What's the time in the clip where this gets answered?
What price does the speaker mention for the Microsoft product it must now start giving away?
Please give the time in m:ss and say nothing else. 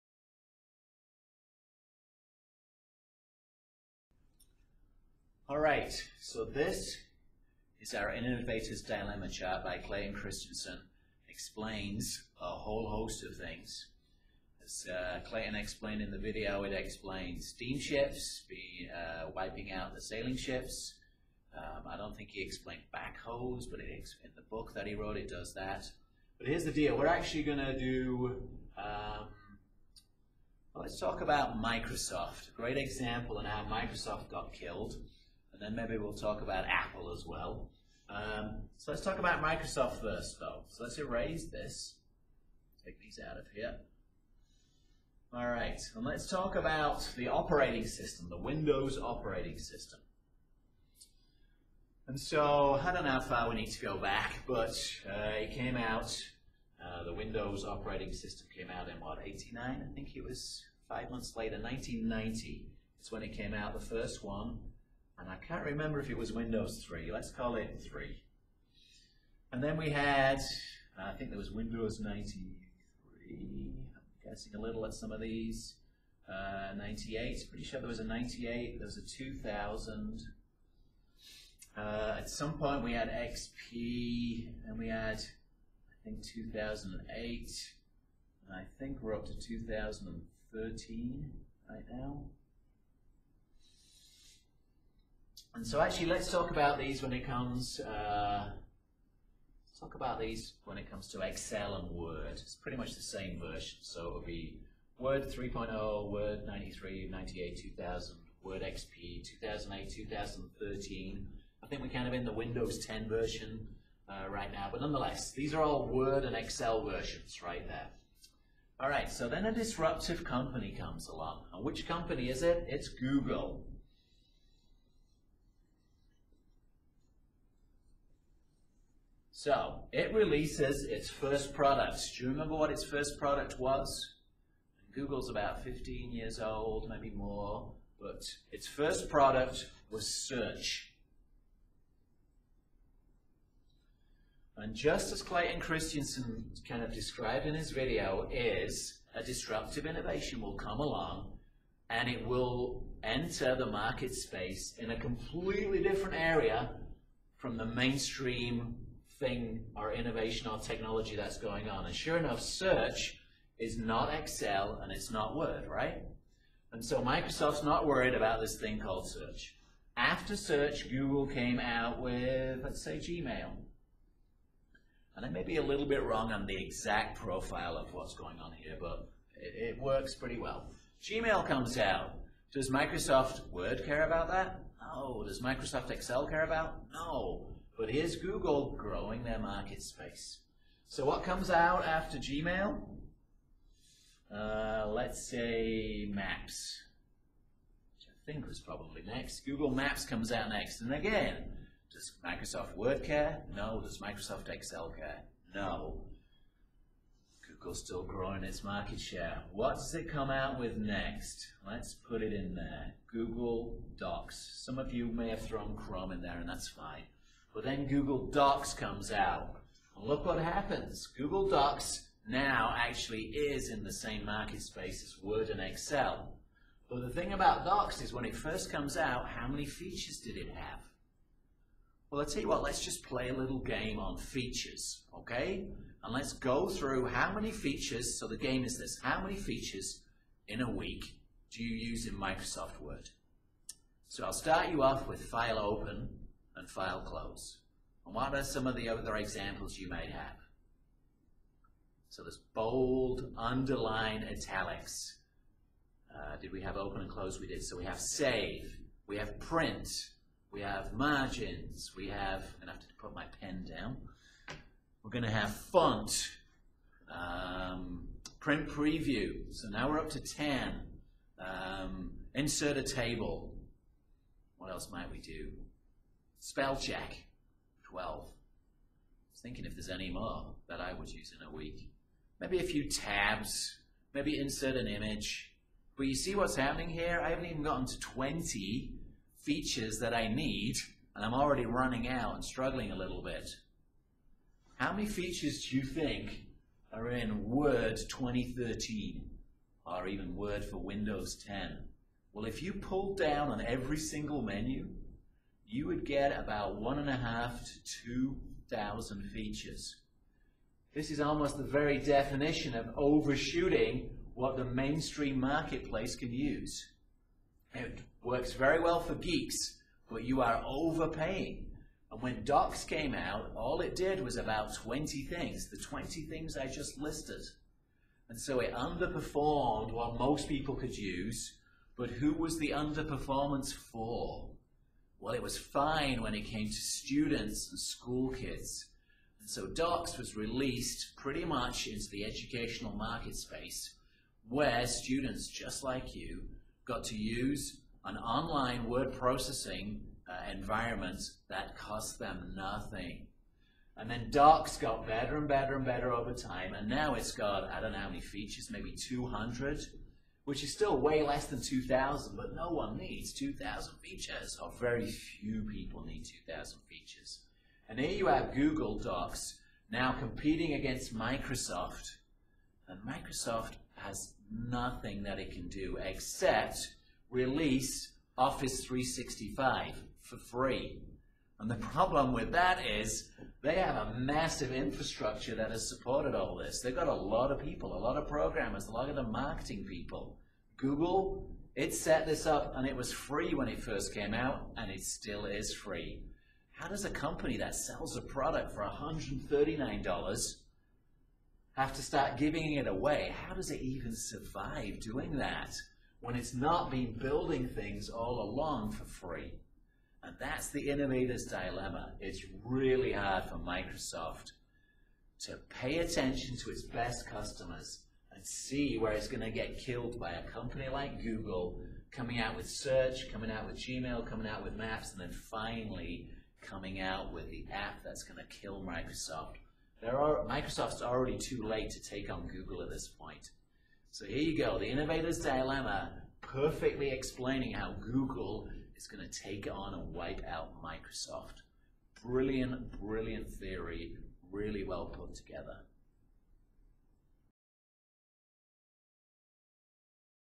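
6:38.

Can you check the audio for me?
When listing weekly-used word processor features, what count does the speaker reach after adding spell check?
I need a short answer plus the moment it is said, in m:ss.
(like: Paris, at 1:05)
12, at 4:37.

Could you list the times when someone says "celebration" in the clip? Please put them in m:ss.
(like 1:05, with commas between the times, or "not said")
not said.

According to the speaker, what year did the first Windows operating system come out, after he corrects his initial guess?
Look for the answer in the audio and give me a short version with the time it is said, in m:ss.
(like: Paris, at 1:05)
1990, at 1:01.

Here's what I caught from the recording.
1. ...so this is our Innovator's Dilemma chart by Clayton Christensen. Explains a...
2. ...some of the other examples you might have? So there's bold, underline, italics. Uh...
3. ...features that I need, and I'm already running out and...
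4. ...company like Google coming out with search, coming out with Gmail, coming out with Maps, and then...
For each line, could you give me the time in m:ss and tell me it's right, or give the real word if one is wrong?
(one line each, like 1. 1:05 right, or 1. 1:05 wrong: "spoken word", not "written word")
1. 0:06 right
2. 4:08 right
3. 4:49 right
4. 7:00 right.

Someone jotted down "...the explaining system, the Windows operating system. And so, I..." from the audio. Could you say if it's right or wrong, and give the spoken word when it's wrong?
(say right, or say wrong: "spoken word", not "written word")
wrong: "operating", not "explaining".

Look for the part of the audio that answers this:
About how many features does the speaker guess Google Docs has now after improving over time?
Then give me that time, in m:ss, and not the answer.
5:58.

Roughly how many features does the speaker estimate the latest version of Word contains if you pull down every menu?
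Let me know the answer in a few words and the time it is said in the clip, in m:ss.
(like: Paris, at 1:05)
1,500 to 2,000, at 5:06.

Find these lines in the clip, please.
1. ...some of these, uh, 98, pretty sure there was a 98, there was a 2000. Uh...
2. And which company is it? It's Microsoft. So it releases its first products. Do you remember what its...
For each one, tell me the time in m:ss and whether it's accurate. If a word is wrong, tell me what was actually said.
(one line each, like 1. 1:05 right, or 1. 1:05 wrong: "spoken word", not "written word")
1. 1:14 right
2. 2:01 wrong: "Google", not "Microsoft".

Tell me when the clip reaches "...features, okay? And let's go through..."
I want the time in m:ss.
3:54.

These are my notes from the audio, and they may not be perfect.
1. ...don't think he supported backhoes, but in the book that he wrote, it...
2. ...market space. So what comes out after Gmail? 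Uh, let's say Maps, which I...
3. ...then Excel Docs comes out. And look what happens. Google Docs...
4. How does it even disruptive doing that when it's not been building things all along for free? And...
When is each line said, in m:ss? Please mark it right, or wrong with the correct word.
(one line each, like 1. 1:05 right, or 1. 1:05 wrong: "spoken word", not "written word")
1. 0:21 wrong: "explained", not "supported"
2. 3:09 right
3. 3:37 wrong: "Google", not "Excel"
4. 6:43 wrong: "survive", not "disruptive".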